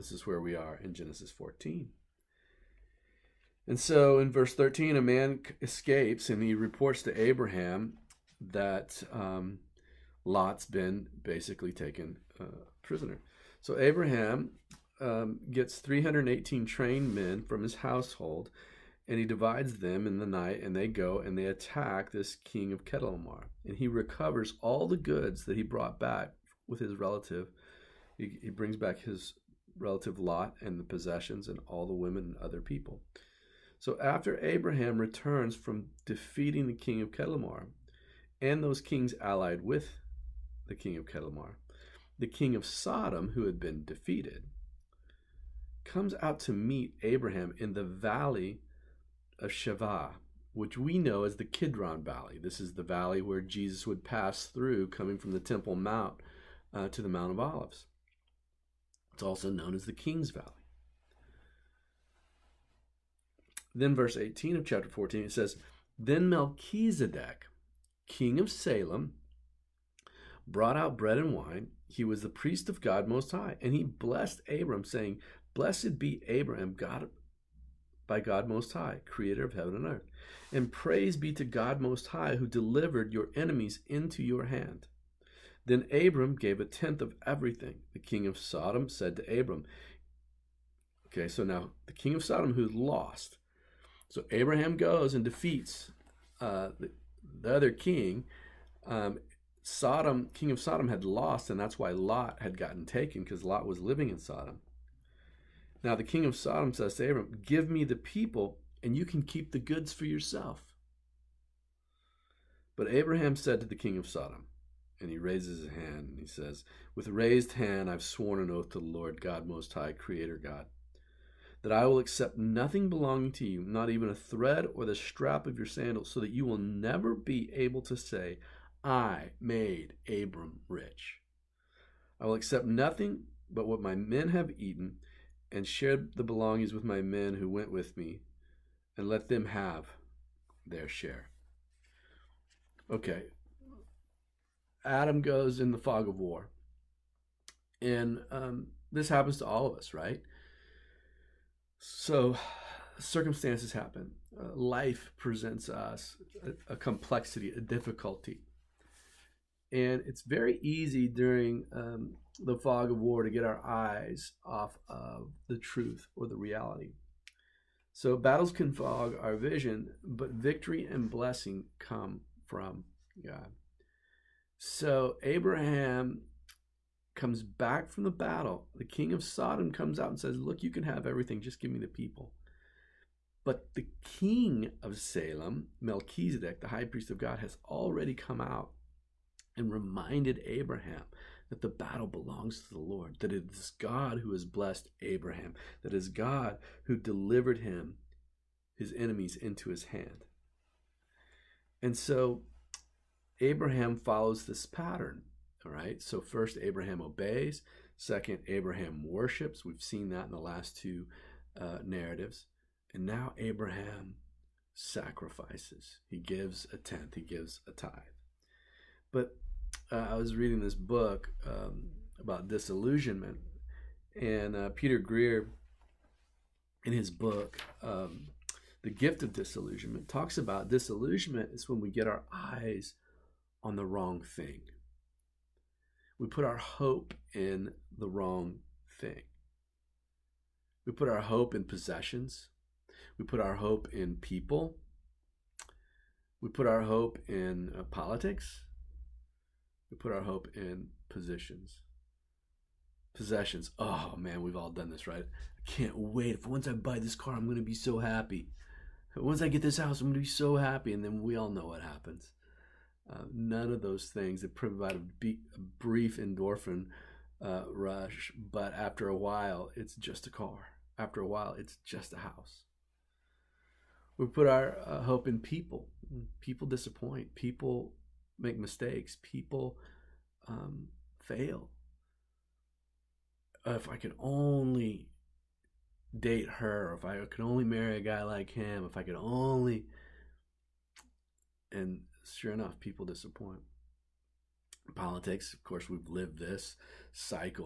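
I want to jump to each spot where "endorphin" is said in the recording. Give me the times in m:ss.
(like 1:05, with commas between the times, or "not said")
4:26.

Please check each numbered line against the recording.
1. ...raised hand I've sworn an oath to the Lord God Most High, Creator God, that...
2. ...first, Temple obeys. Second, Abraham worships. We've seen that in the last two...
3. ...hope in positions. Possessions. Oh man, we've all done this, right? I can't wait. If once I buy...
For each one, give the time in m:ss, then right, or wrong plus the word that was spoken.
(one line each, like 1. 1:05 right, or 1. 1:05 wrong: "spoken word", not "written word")
1. 1:57 right
2. 3:26 wrong: "Abraham", not "Temple"
3. 4:10 right.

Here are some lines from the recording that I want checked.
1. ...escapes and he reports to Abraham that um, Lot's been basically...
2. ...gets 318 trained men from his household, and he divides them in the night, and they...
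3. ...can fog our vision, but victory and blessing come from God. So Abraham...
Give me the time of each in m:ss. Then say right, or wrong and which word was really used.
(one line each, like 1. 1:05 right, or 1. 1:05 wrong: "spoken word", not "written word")
1. 0:05 right
2. 0:15 right
3. 2:48 right.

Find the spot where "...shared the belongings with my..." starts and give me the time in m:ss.
2:15.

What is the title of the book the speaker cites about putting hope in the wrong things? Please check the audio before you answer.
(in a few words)
The Gift of Disillusionment.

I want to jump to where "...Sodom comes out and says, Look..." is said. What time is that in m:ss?
2:59.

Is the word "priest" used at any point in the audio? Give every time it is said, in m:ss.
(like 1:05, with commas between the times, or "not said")
1:12, 3:06.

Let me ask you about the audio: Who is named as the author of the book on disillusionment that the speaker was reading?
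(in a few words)
Peter Greer.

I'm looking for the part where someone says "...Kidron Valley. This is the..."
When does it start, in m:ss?
0:51.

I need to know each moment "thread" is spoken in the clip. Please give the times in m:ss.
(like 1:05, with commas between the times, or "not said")
2:04.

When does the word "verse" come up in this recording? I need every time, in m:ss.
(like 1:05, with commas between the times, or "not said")
0:04, 1:03.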